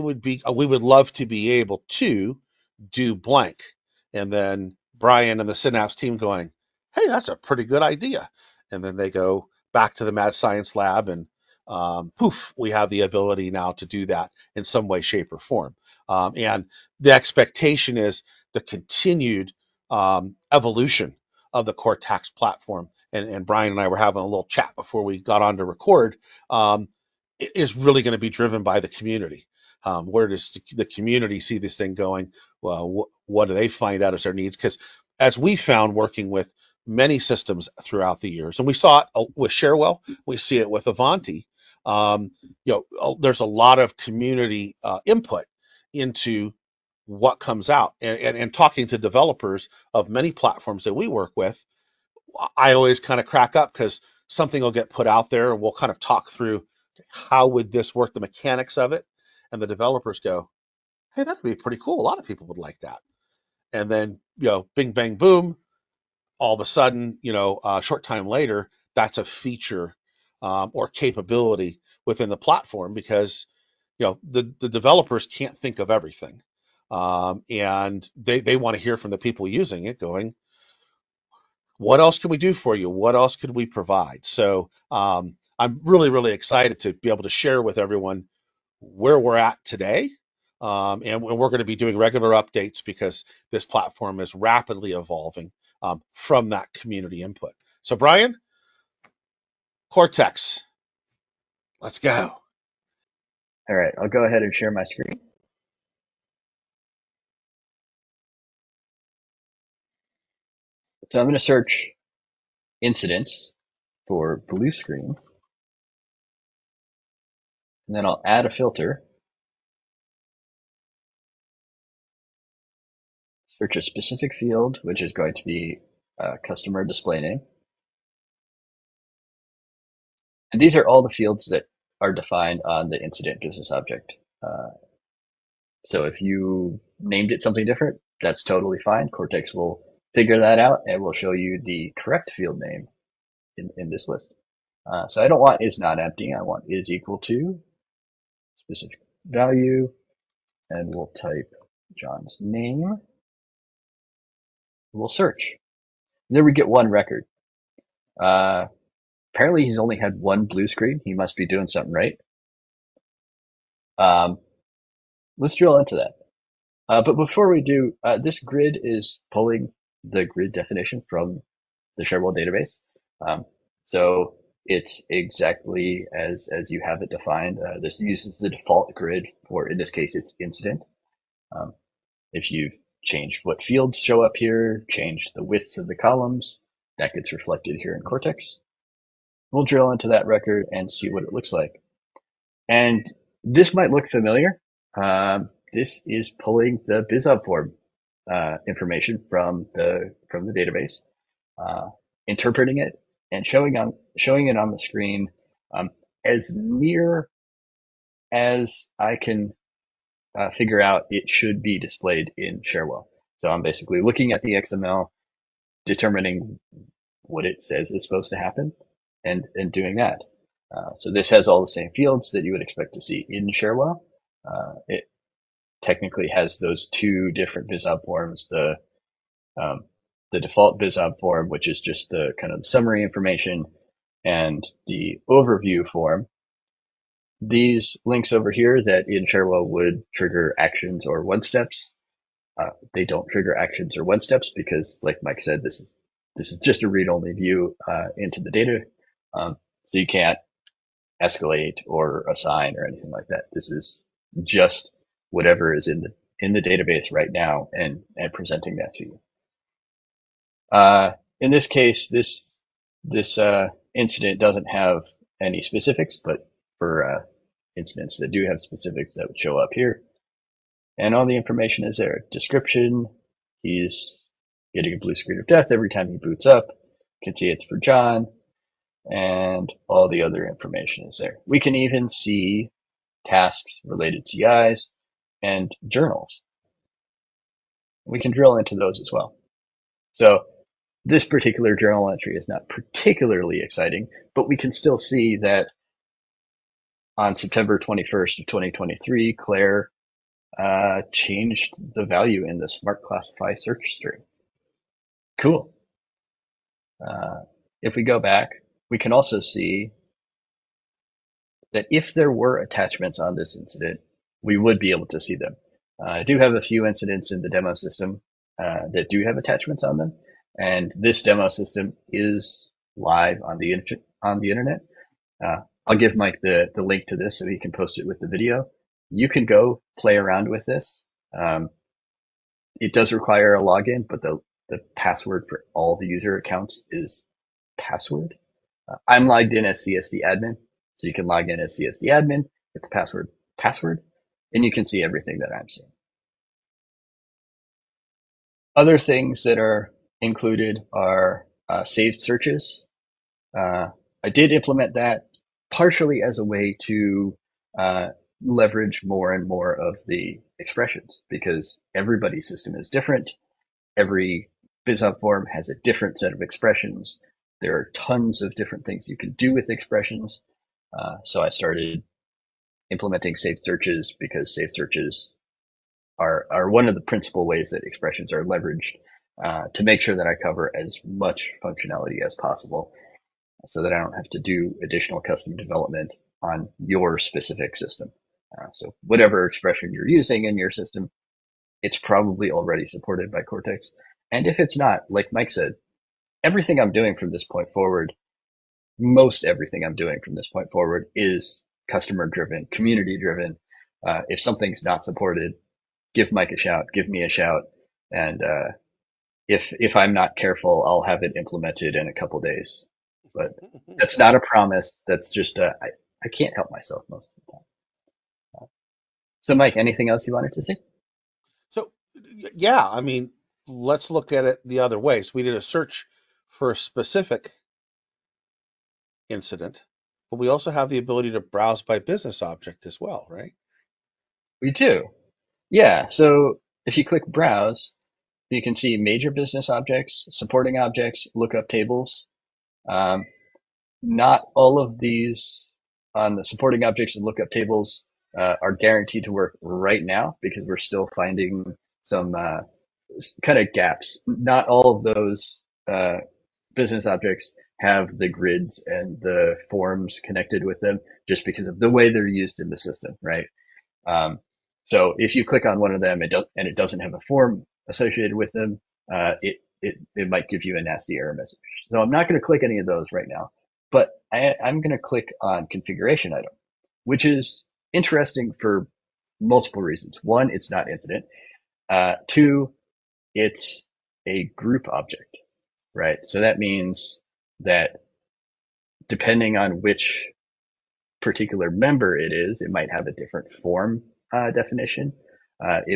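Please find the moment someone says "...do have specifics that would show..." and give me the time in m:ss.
4:28.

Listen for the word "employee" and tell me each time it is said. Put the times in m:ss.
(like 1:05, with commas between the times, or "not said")
not said.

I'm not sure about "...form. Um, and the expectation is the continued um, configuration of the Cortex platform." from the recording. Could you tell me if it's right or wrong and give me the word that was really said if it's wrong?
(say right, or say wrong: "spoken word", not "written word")
wrong: "evolution", not "configuration".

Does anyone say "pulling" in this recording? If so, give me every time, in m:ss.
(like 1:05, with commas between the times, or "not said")
2:49, 3:16.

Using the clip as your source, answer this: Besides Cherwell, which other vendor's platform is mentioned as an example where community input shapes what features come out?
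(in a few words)
Ivanti.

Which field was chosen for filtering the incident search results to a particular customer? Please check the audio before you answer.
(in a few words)
customer display name.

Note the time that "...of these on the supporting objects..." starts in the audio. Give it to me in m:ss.
7:24.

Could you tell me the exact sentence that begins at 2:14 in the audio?
Uh, so if you named it something different, that's totally fine.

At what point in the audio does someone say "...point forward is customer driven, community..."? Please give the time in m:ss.
6:40.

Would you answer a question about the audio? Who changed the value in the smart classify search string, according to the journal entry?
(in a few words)
Claire.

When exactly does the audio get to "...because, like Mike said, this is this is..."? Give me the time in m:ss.
4:04.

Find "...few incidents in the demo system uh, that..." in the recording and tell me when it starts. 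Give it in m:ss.
5:16.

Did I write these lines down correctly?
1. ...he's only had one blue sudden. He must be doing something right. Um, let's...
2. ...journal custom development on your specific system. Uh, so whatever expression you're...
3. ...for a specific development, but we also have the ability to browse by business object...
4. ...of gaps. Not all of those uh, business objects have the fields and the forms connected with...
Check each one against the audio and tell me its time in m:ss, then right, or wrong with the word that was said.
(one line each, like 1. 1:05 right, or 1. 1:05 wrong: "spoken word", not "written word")
1. 2:39 wrong: "screen", not "sudden"
2. 6:24 wrong: "additional", not "journal"
3. 7:06 wrong: "incident", not "development"
4. 7:33 wrong: "grids", not "fields".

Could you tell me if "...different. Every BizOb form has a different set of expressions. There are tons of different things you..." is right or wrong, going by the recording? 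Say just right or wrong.
right.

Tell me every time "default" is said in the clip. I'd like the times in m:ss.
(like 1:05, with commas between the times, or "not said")
2:58, 3:50.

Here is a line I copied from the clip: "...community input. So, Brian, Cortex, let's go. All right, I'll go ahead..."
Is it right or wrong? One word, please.
right.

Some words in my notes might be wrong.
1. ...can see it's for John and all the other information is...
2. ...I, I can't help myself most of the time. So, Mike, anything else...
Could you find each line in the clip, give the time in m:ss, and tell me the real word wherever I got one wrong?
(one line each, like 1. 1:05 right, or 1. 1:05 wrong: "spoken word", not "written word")
1. 4:37 right
2. 6:55 right.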